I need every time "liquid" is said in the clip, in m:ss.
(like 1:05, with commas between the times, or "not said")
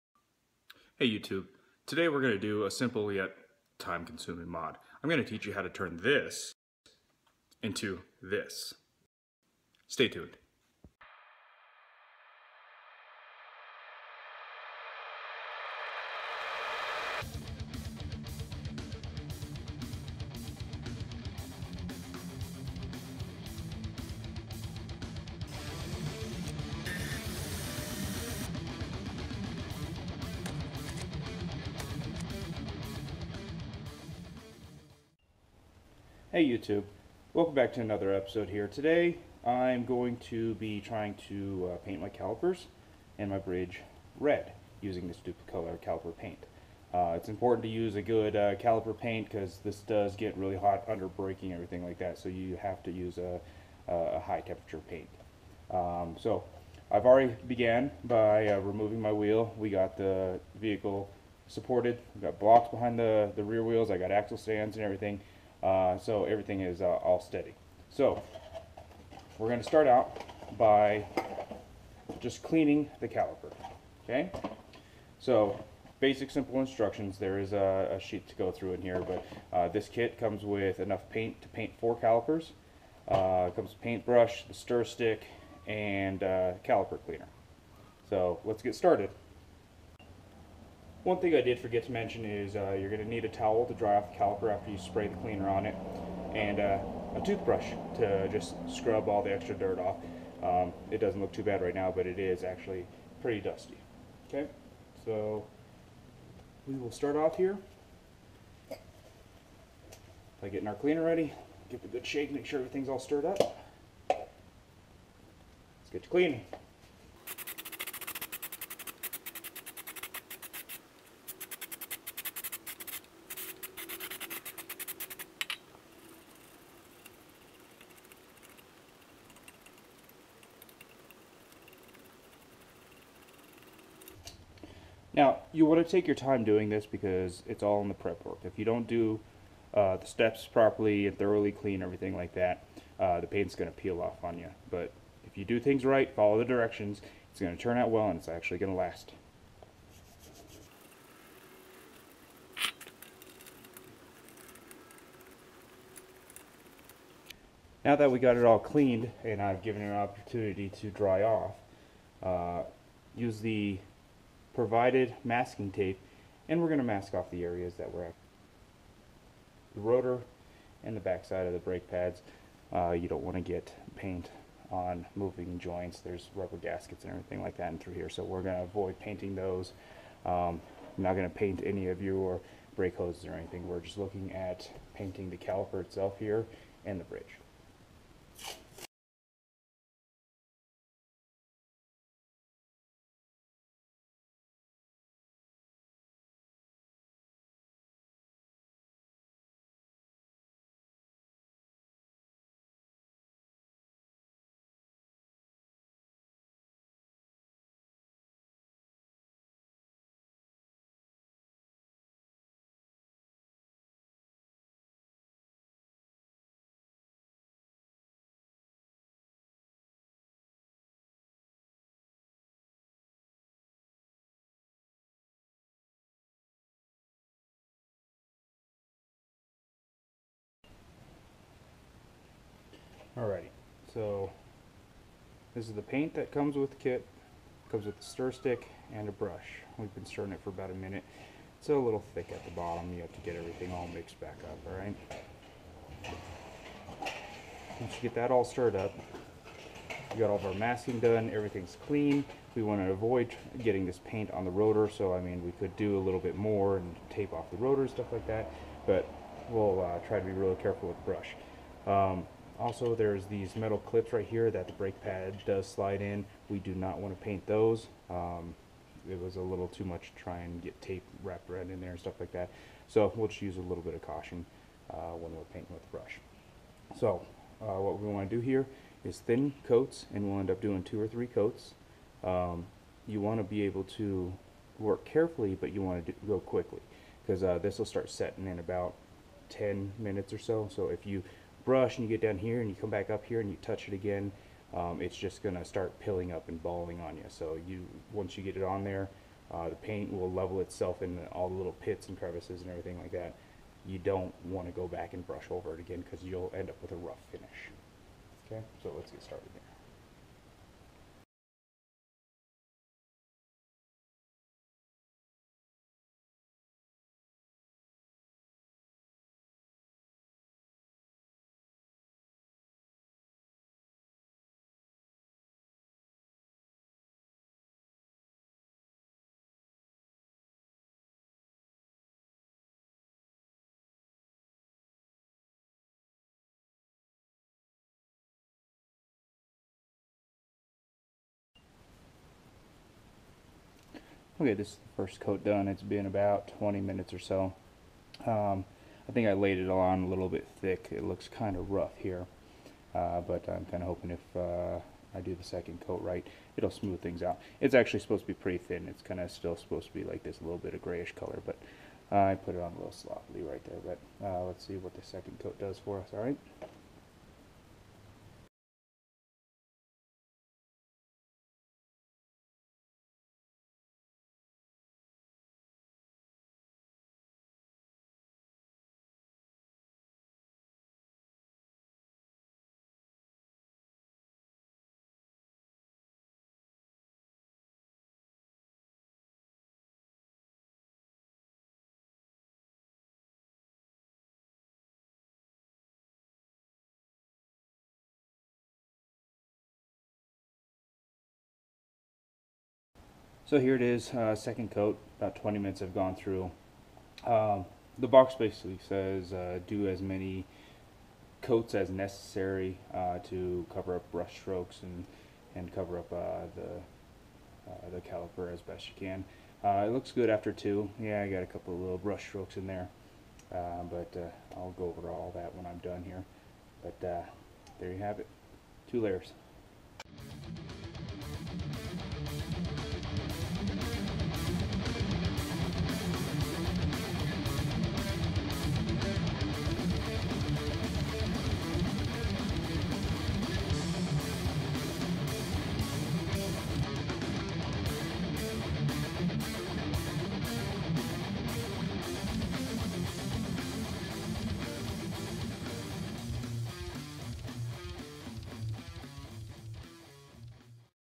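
not said.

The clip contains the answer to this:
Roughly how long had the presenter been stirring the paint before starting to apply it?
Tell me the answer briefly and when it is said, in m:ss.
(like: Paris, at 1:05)
About a minute, at 4:00.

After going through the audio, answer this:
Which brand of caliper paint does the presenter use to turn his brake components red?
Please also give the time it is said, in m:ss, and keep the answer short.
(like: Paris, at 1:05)
Duplicolor, at 0:45.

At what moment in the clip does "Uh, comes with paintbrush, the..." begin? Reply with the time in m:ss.
1:23.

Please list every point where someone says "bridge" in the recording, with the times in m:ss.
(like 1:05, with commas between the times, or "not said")
0:43, 3:07.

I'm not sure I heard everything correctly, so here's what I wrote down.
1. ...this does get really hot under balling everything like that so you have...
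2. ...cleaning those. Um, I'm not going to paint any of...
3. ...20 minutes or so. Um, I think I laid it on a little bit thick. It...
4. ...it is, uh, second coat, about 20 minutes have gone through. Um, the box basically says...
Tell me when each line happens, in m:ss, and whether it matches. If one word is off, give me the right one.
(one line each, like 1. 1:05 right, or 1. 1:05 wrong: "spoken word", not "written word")
1. 0:49 wrong: "braking", not "balling"
2. 2:58 wrong: "painting", not "cleaning"
3. 5:46 right
4. 6:43 right.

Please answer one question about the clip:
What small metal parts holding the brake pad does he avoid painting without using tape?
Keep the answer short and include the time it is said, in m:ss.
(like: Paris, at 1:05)
Metal clips, at 4:23.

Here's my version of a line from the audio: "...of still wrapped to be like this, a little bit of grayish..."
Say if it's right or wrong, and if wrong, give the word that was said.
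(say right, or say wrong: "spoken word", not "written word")
wrong: "supposed", not "wrapped".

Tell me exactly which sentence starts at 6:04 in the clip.
But uh, let's see what the second coat does for us, all right?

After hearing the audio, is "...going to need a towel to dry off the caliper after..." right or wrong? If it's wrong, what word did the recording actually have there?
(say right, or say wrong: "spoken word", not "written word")
right.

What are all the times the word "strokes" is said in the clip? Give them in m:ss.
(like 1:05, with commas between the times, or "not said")
6:54, 7:02.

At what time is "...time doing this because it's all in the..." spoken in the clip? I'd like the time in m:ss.
2:16.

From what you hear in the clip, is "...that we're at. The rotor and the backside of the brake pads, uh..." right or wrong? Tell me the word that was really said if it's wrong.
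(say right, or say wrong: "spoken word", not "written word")
right.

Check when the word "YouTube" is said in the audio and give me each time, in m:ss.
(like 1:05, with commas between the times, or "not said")
0:01, 0:36.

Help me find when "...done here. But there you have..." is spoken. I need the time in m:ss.
7:05.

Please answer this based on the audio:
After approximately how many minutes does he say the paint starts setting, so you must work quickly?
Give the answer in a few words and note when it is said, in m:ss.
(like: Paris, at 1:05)
10 minutes, at 4:49.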